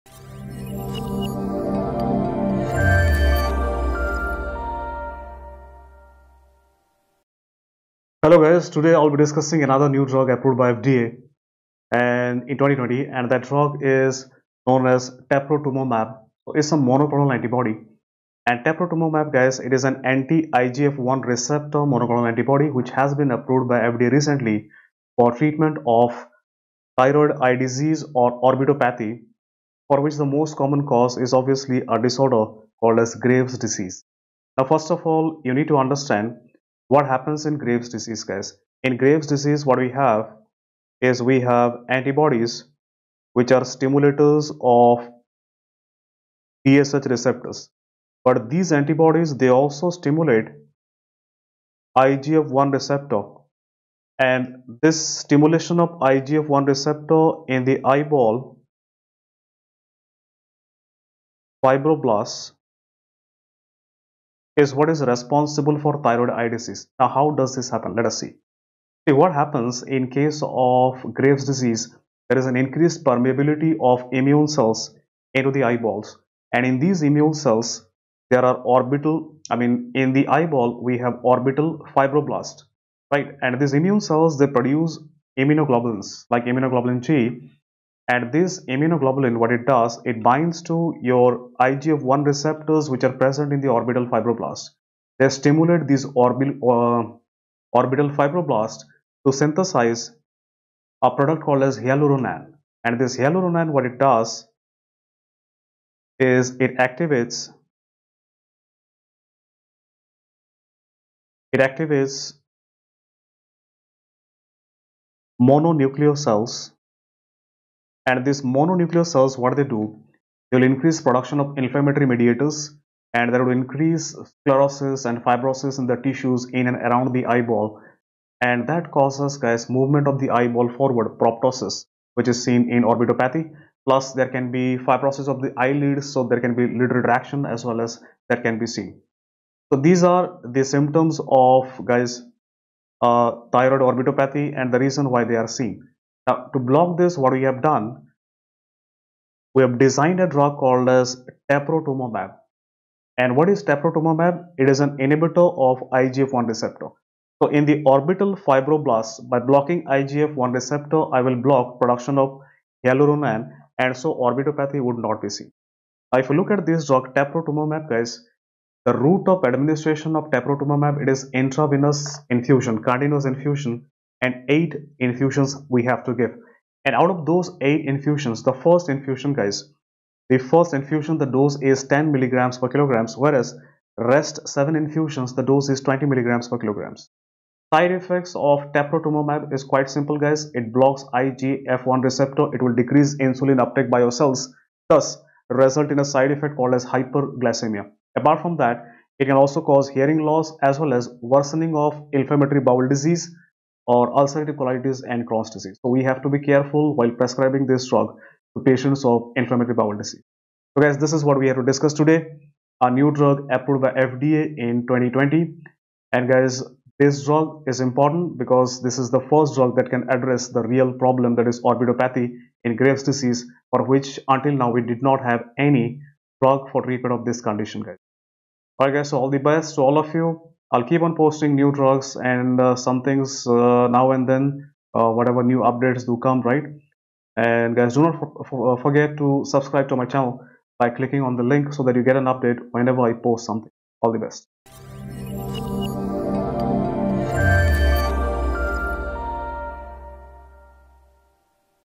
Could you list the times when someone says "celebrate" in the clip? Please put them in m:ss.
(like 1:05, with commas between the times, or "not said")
not said.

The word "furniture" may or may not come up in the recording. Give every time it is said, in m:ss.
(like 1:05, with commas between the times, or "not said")
not said.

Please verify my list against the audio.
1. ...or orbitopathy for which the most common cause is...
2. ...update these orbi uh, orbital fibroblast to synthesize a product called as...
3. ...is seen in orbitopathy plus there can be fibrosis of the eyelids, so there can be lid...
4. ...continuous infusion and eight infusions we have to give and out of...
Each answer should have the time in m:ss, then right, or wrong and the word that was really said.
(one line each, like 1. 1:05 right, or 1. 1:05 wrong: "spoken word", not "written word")
1. 0:28 right
2. 1:35 wrong: "stimulate", not "update"
3. 2:12 right
4. 2:52 right.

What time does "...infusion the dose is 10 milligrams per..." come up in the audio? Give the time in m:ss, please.
3:00.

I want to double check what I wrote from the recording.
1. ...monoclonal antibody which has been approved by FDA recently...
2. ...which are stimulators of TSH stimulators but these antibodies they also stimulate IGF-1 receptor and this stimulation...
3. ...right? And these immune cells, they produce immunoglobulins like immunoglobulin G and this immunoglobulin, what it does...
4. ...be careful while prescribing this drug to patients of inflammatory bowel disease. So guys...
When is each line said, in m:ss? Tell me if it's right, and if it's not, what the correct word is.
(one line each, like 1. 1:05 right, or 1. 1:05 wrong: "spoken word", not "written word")
1. 0:21 right
2. 0:43 wrong: "receptors", not "stimulators"
3. 1:23 right
4. 3:26 right.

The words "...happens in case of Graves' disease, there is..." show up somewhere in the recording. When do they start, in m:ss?
1:09.